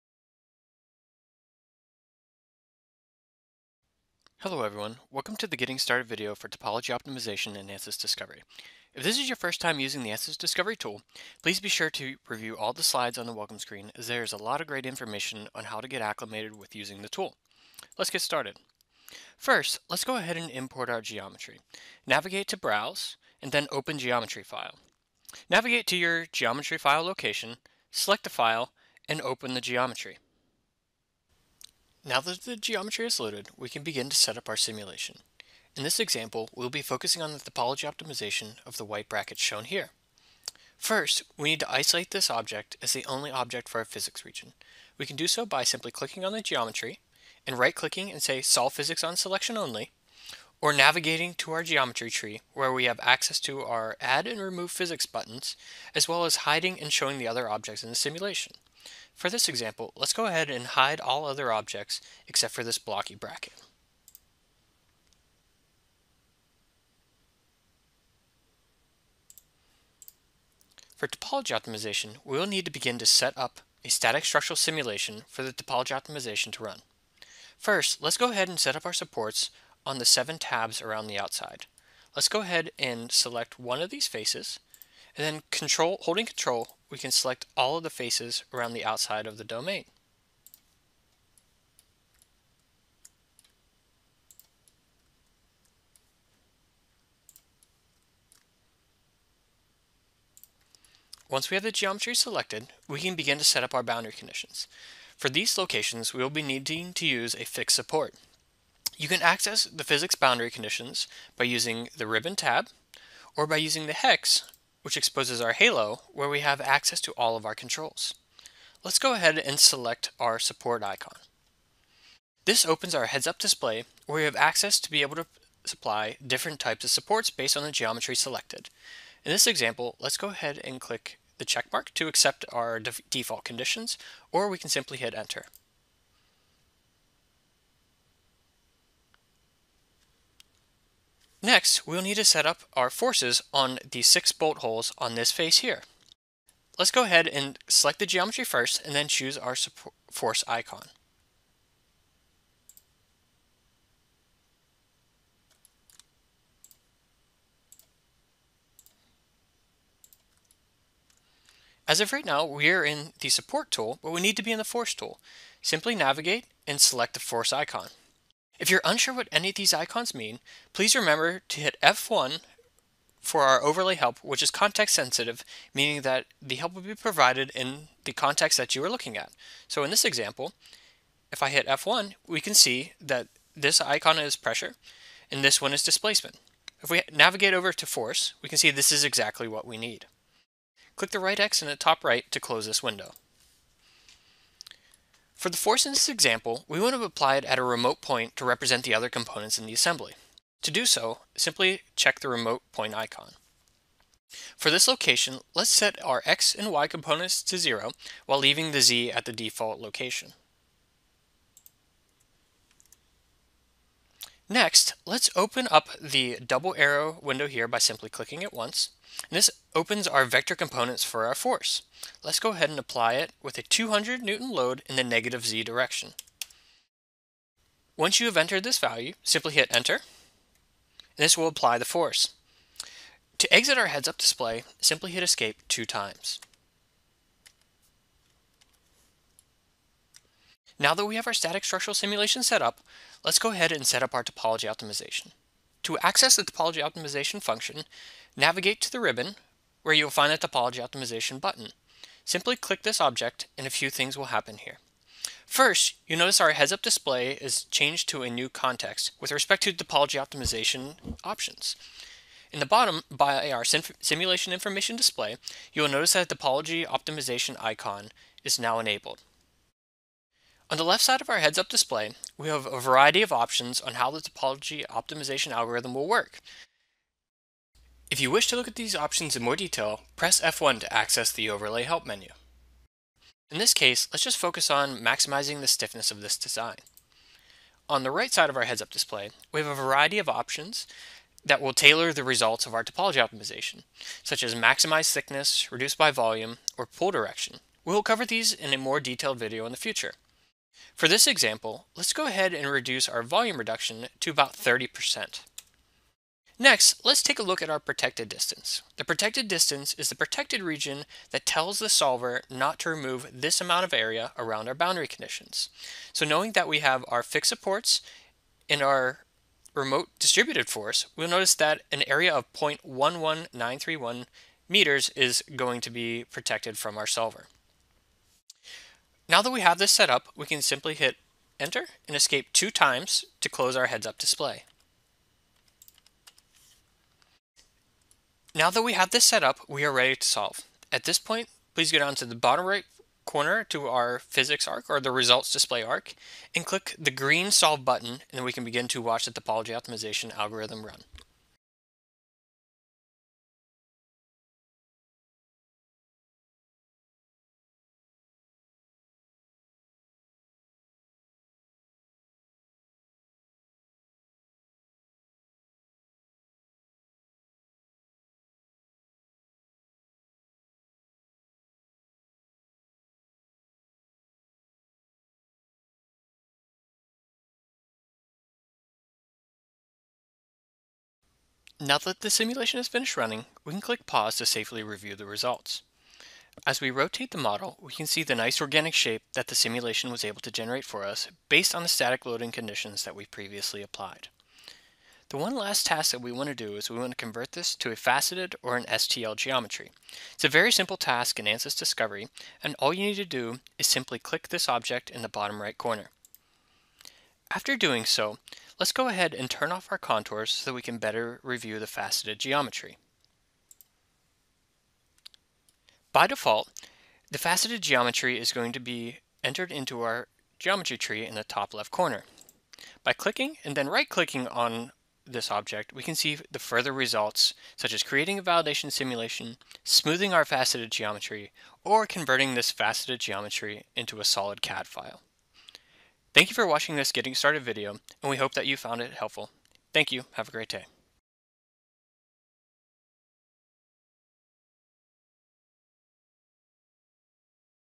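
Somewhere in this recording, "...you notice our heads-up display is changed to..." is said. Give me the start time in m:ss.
4:16.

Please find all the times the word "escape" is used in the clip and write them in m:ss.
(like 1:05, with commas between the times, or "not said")
3:55, 5:32.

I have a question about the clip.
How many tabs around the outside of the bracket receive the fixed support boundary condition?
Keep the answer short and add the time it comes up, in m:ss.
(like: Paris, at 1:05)
7, at 1:20.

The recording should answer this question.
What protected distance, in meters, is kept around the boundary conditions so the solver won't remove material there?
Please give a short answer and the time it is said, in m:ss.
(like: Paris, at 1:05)
0.11931 meters, at 5:22.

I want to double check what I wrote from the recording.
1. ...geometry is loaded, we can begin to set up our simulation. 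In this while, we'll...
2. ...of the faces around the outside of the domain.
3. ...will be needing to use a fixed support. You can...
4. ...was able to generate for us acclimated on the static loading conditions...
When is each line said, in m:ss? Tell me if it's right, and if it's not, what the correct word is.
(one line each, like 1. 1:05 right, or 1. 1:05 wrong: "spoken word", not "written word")
1. 0:32 wrong: "example", not "while"
2. 1:27 right
3. 1:46 right
4. 6:30 wrong: "based", not "acclimated".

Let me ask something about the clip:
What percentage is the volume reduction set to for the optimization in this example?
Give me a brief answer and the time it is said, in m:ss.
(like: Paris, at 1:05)
30%, at 5:04.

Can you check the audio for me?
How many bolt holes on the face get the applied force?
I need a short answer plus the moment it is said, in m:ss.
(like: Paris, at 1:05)
6, at 2:24.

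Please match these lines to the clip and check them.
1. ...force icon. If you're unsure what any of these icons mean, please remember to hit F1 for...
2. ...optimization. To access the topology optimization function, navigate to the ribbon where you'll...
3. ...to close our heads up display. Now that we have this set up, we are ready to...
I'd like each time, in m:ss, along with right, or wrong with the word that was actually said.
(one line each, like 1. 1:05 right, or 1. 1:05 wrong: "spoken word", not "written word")
1. 2:47 right
2. 4:04 right
3. 5:33 right.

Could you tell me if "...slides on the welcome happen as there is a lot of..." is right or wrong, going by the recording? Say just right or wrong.
wrong.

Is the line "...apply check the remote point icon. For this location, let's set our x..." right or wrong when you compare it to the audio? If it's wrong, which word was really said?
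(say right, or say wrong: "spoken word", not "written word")
wrong: "simply", not "apply".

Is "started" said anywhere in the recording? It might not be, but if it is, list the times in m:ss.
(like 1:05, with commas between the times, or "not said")
0:05, 0:18, 7:17.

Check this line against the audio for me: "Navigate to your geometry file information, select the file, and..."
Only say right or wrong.
wrong.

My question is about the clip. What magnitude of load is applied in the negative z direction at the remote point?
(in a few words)
200 newtons.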